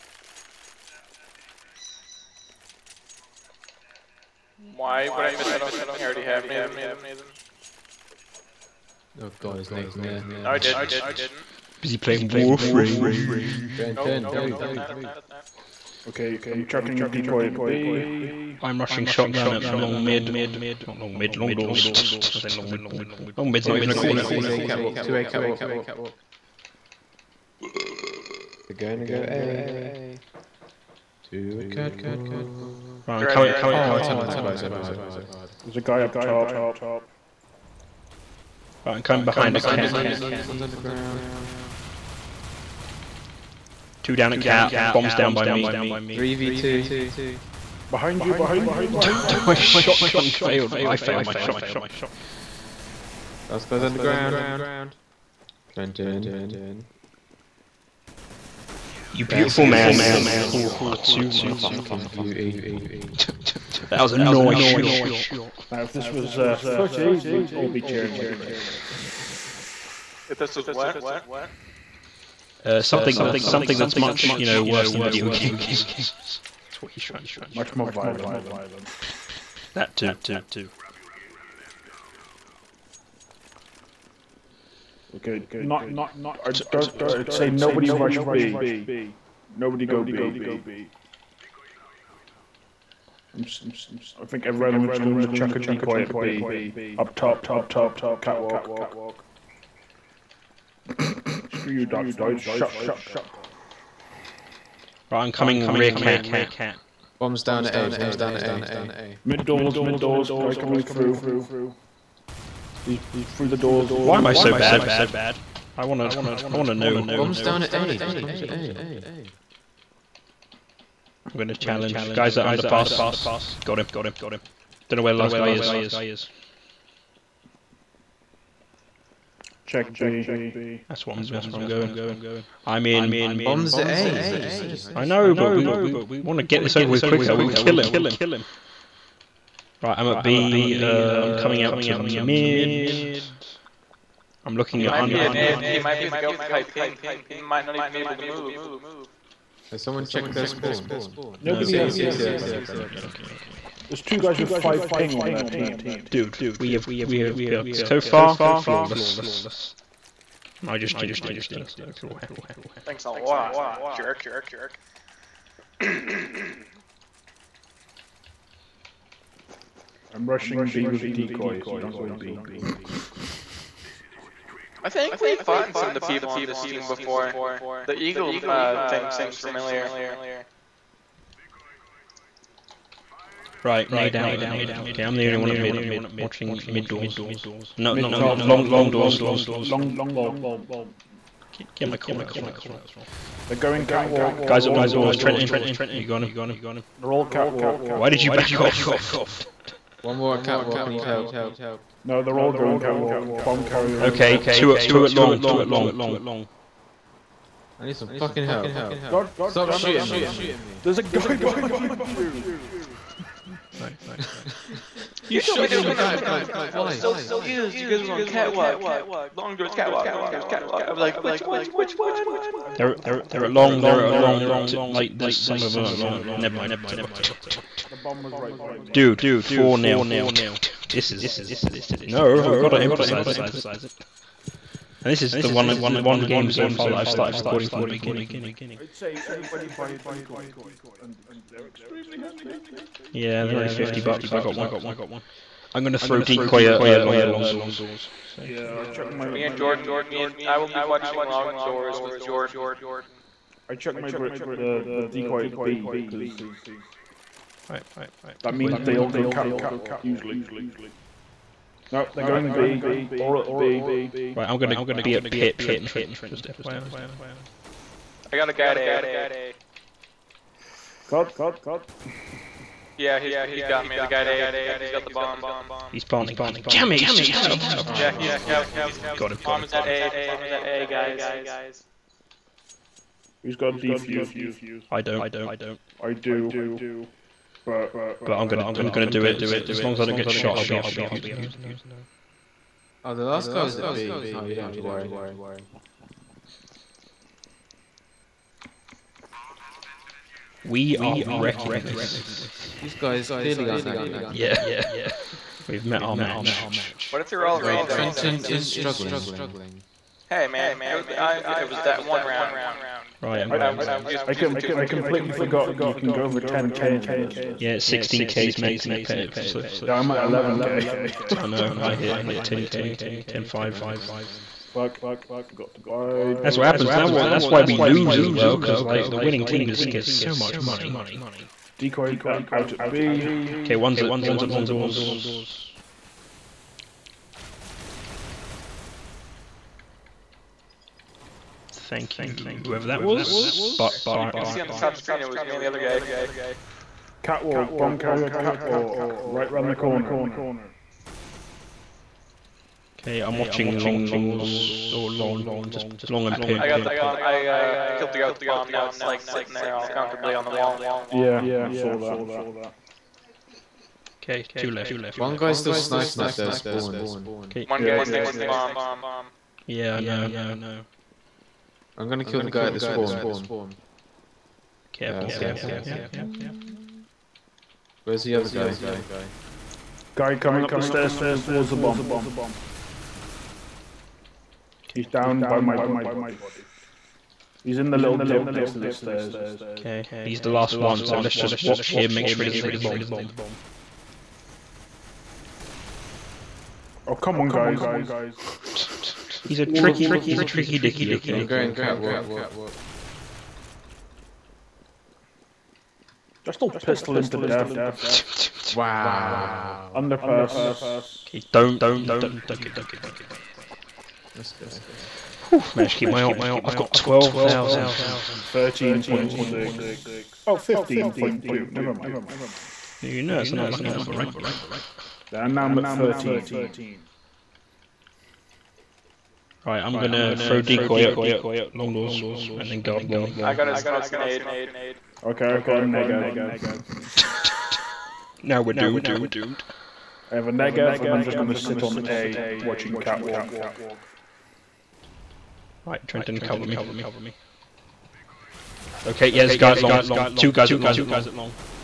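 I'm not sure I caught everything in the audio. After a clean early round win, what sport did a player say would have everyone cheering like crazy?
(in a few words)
Footy.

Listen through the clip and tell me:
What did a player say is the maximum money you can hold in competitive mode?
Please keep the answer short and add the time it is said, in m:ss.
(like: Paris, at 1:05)
16k, at 5:17.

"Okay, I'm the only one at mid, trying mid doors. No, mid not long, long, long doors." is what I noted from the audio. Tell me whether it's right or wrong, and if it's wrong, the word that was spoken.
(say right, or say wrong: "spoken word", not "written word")
wrong: "watching", not "trying".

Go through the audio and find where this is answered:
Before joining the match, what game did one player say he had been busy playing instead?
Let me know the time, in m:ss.
0:12.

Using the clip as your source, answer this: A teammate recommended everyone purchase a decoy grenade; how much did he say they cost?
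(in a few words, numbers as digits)
50 bucks.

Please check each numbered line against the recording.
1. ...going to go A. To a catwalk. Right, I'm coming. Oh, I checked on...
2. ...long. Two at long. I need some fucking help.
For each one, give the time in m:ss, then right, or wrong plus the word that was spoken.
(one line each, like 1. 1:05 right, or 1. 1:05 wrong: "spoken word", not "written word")
1. 0:28 wrong: "turned", not "checked"
2. 3:25 right.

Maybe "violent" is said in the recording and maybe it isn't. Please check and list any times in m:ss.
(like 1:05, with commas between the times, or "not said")
1:17.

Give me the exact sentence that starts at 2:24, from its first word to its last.
I'm looking he at might an, He might be the guy with the high ping.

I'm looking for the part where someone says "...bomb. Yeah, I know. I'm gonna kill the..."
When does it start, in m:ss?
6:08.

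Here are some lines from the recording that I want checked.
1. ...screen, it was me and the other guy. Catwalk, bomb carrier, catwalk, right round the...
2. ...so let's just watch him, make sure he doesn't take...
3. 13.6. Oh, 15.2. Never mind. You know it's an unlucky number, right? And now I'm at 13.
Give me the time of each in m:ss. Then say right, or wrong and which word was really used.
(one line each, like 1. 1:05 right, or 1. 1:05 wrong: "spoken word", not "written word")
1. 5:44 right
2. 6:31 right
3. 6:57 right.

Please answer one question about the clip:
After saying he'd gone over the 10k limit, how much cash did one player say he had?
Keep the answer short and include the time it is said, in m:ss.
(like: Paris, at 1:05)
11k, at 5:20.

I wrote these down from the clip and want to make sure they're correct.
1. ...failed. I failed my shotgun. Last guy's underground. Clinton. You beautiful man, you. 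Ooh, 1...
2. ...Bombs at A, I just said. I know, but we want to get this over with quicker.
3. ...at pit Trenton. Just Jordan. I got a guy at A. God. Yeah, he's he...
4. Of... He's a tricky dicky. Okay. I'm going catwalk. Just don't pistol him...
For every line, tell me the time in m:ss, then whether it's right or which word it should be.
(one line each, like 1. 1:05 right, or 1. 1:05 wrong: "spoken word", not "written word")
1. 0:50 wrong: "2", not "1"
2. 2:13 right
3. 4:25 wrong: "FYI", not "Jordan"
4. 6:40 right.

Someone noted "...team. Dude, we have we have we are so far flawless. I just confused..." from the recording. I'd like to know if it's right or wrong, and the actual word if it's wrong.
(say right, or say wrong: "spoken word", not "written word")
wrong: "jinxed", not "confused".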